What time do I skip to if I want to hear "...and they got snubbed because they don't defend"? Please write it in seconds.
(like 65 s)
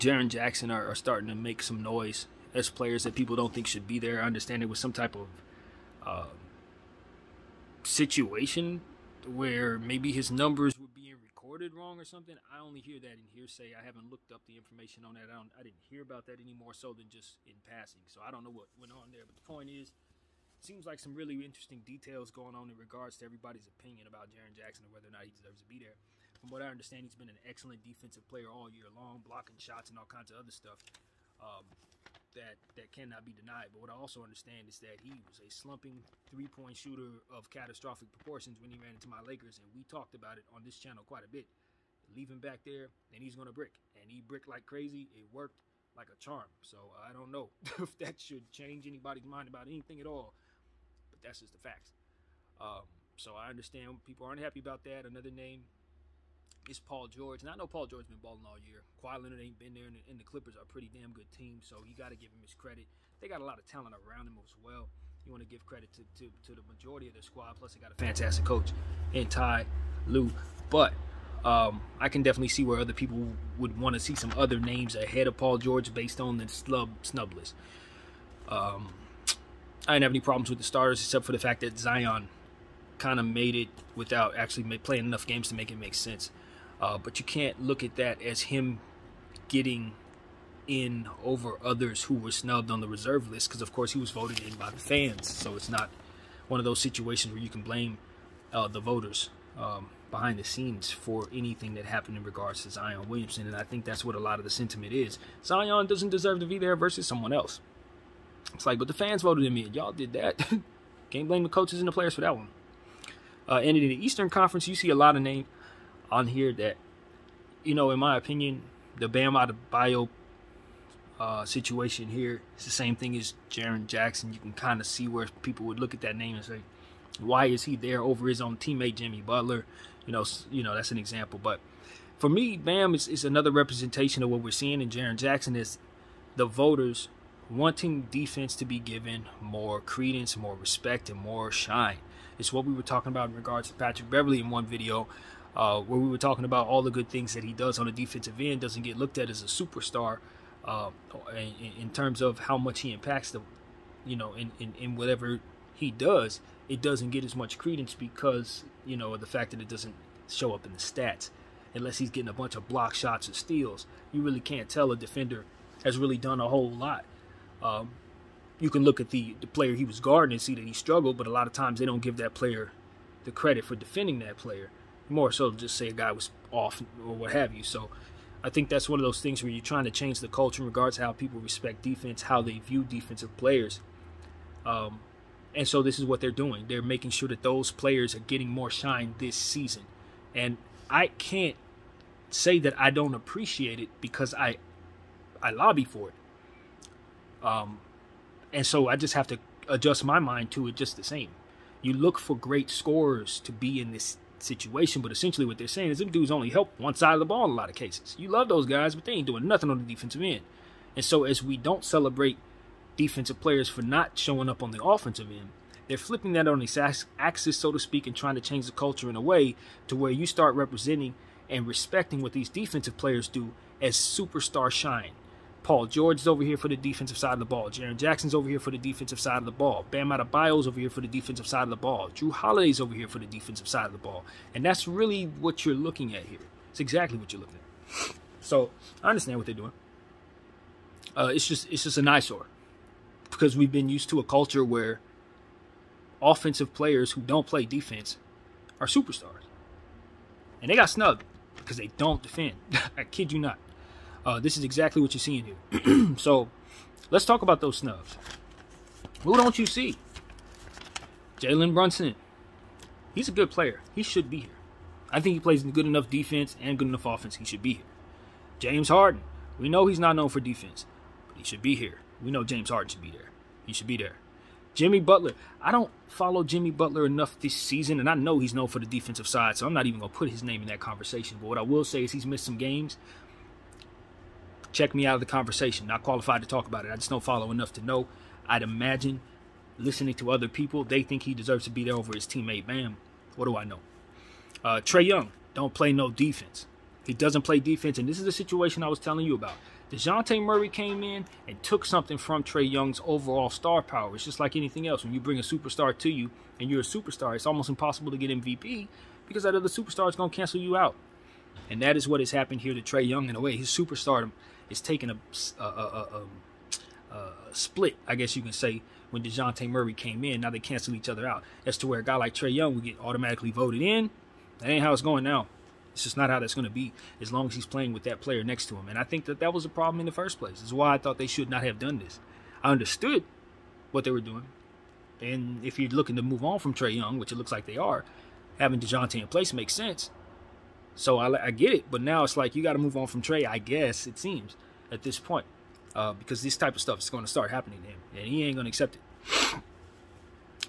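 250 s.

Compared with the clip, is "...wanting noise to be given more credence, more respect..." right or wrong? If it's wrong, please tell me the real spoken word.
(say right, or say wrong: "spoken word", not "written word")
wrong: "defense", not "noise".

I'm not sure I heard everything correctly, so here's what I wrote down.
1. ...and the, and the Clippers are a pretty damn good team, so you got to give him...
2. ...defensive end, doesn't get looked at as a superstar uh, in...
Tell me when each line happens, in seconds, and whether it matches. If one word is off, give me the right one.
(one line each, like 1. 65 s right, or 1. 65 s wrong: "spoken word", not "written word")
1. 59 s right
2. 147 s right.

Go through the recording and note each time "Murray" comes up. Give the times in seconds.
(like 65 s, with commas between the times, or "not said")
300 s, 319 s.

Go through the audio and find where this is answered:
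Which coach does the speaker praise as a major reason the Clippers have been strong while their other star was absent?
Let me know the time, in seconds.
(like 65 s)
69 s.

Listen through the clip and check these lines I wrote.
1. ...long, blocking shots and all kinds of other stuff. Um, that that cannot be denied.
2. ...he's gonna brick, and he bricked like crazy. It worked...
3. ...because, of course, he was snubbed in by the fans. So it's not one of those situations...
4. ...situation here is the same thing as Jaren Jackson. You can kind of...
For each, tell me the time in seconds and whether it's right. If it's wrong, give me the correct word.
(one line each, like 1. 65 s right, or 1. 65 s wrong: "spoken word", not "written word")
1. 28 s right
2. 43 s right
3. 93 s wrong: "voted", not "snubbed"
4. 121 s right.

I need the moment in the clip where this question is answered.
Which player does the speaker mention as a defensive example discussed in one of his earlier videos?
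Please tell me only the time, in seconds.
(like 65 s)
143 s.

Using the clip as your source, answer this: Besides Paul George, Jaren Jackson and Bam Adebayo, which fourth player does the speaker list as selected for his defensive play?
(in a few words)
Jrue Holiday.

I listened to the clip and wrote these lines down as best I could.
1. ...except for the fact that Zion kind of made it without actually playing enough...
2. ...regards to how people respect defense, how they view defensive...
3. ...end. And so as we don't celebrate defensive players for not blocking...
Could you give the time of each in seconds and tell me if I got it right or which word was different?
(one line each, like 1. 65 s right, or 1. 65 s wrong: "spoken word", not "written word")
1. 81 s right
2. 180 s right
3. 210 s wrong: "showing", not "blocking".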